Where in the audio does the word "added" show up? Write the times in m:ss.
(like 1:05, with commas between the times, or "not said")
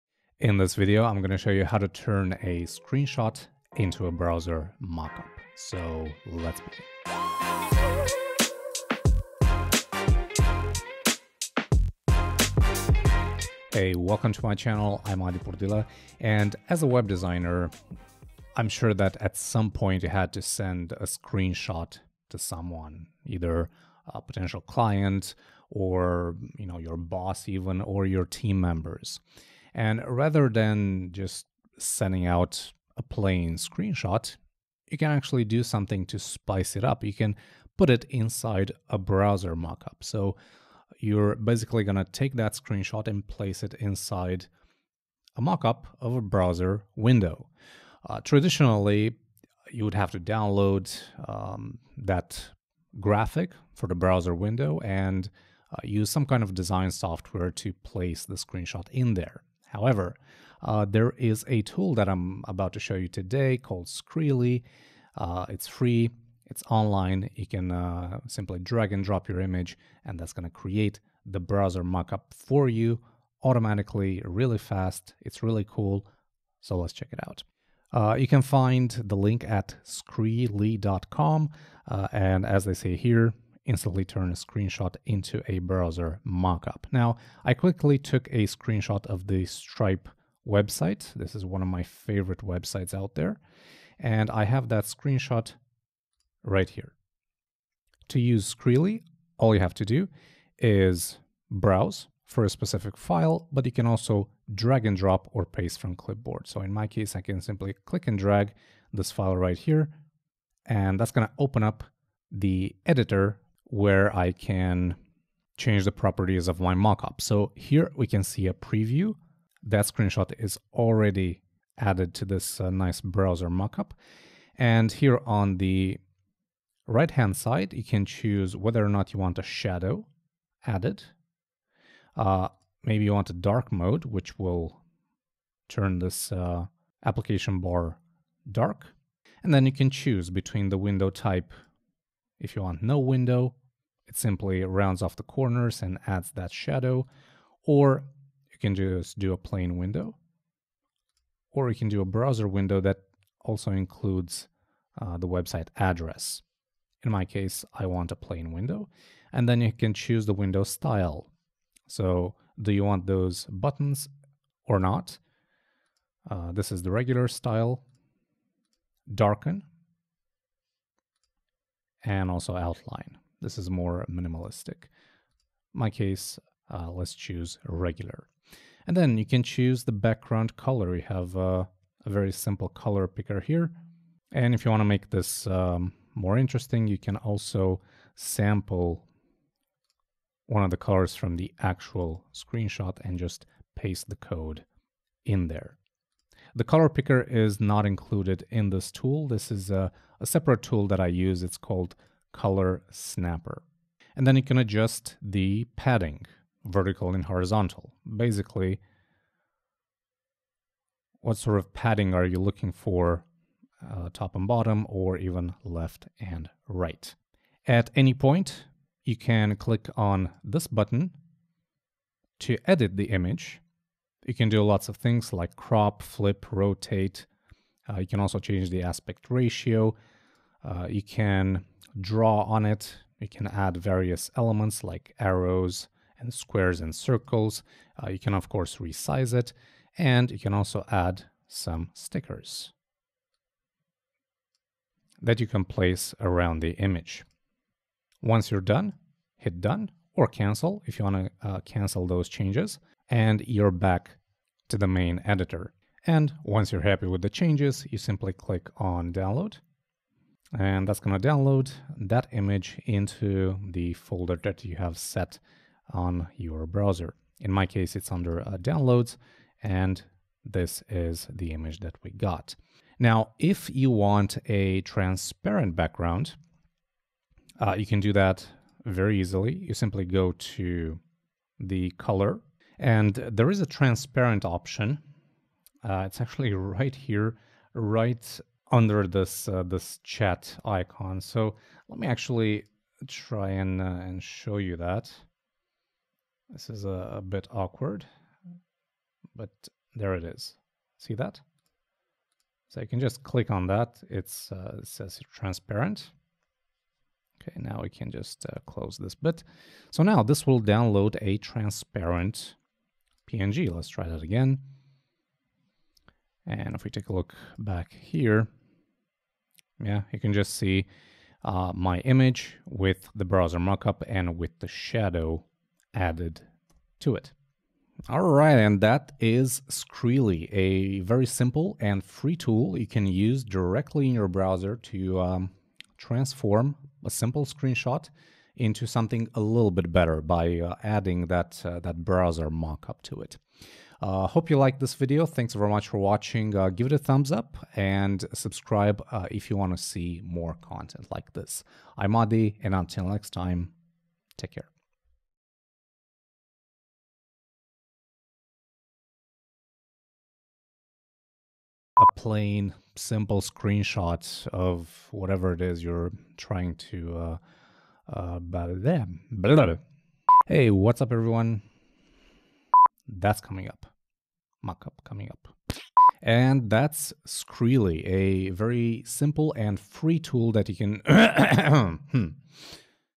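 2:01, 2:10, 5:25.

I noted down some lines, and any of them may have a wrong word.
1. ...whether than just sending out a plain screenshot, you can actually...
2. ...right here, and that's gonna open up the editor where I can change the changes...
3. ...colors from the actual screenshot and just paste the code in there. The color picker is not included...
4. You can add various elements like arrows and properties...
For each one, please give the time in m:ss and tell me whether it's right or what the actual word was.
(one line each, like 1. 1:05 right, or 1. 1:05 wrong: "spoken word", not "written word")
1. 0:30 wrong: "rather", not "whether"
2. 1:49 wrong: "properties", not "changes"
3. 3:10 right
4. 3:53 wrong: "squares", not "properties".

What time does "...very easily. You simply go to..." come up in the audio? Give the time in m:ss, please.
4:38.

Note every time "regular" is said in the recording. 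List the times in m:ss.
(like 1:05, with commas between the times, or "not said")
2:46, 2:57.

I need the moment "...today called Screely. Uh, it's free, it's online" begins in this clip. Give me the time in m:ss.
1:03.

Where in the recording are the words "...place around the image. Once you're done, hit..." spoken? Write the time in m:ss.
4:05.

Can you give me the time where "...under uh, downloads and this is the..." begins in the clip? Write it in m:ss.
4:28.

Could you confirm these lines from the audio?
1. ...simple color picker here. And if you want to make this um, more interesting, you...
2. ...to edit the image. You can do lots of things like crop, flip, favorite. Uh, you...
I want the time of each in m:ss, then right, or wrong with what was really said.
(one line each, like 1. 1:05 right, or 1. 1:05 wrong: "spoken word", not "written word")
1. 3:02 right
2. 3:42 wrong: "rotate", not "favorite".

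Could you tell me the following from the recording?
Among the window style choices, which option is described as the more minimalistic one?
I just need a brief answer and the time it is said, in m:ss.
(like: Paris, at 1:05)
Outline, at 2:52.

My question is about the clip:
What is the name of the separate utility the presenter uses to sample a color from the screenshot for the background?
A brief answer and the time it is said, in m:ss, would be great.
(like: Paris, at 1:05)
Color Snapper, at 3:22.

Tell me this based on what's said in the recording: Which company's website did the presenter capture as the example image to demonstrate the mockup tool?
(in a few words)
Stripe.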